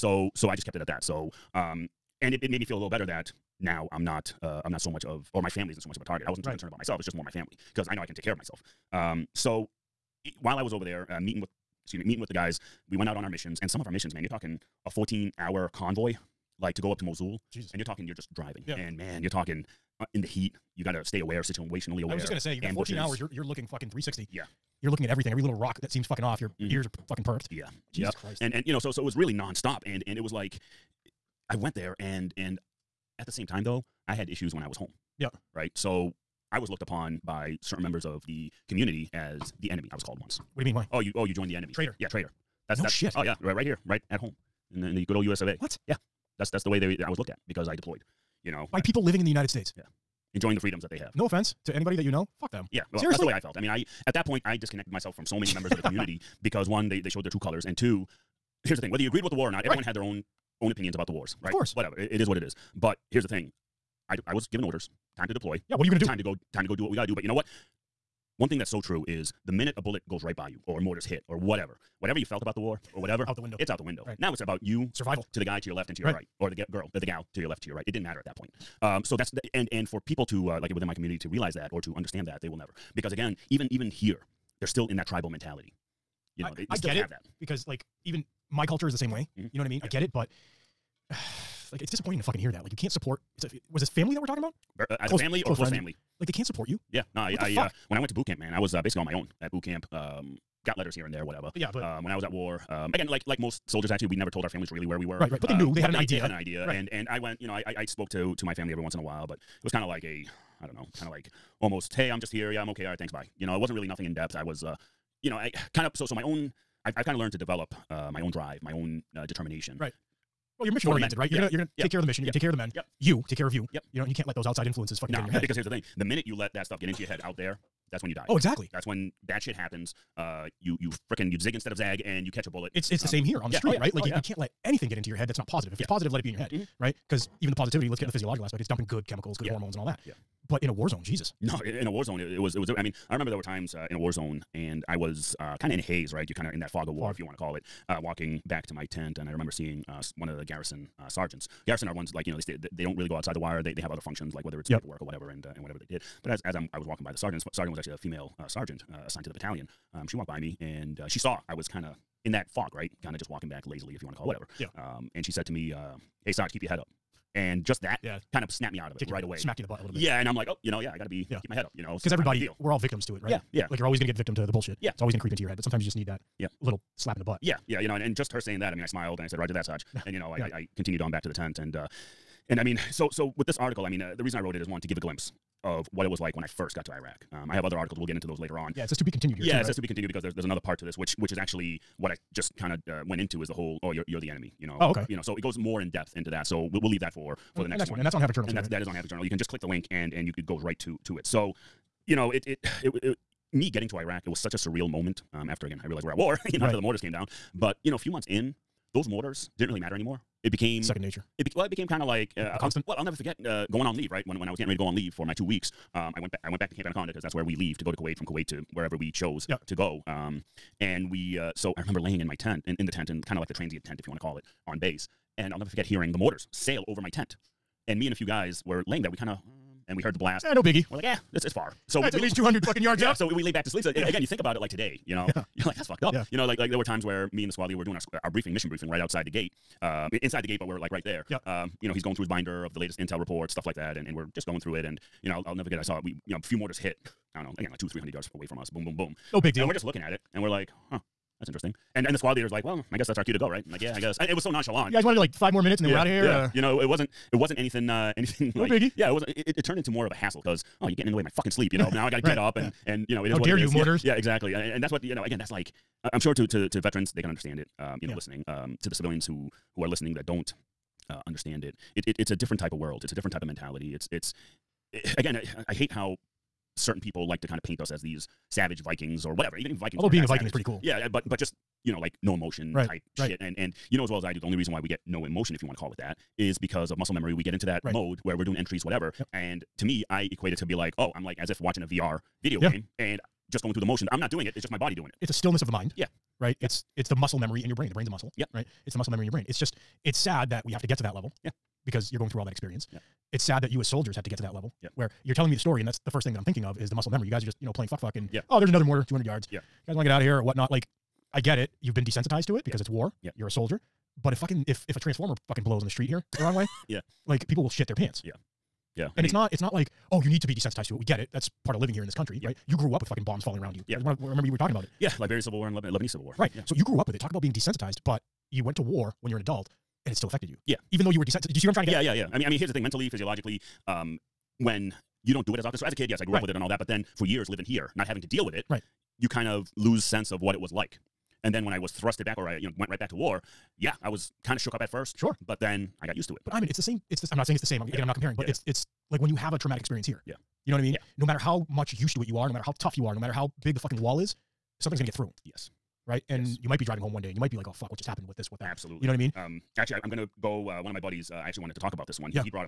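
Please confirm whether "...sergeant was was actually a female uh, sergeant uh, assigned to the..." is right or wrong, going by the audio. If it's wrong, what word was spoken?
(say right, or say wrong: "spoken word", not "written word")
right.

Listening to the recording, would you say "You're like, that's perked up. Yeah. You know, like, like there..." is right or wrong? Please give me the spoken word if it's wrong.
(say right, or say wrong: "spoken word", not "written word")
wrong: "fucked", not "perked".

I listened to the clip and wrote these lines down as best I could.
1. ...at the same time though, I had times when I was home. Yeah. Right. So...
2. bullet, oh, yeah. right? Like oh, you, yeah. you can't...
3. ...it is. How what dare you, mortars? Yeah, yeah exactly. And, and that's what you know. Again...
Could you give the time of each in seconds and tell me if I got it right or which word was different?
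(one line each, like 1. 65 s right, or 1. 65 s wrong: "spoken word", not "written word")
1. 33 s wrong: "issues", not "times"
2. 133 s wrong: "street", not "bullet"
3. 263 s right.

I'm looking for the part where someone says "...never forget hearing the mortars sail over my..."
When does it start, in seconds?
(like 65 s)
225 s.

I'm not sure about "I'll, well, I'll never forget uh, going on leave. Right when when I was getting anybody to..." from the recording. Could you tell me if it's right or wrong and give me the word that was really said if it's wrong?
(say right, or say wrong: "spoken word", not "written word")
wrong: "ready", not "anybody".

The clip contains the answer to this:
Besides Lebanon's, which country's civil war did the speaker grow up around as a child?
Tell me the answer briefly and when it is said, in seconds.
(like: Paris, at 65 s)
Liberia, at 325 s.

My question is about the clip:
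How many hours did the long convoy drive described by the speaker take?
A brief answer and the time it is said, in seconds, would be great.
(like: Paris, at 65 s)
14, at 14 s.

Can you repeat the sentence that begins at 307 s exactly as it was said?
You guys are just, you know, playing fuck fuck and yeah.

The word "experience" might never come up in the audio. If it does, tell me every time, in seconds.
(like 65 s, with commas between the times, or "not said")
302 s, 349 s.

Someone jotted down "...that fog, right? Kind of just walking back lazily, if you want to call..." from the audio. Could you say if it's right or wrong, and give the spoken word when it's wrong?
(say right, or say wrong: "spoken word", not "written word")
right.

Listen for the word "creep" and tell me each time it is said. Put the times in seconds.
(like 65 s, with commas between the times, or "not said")
175 s.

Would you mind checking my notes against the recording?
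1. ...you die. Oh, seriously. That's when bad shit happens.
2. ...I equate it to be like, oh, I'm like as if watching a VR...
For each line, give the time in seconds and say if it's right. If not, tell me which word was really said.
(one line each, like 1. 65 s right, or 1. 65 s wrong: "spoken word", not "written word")
1. 128 s wrong: "exactly", not "seriously"
2. 290 s right.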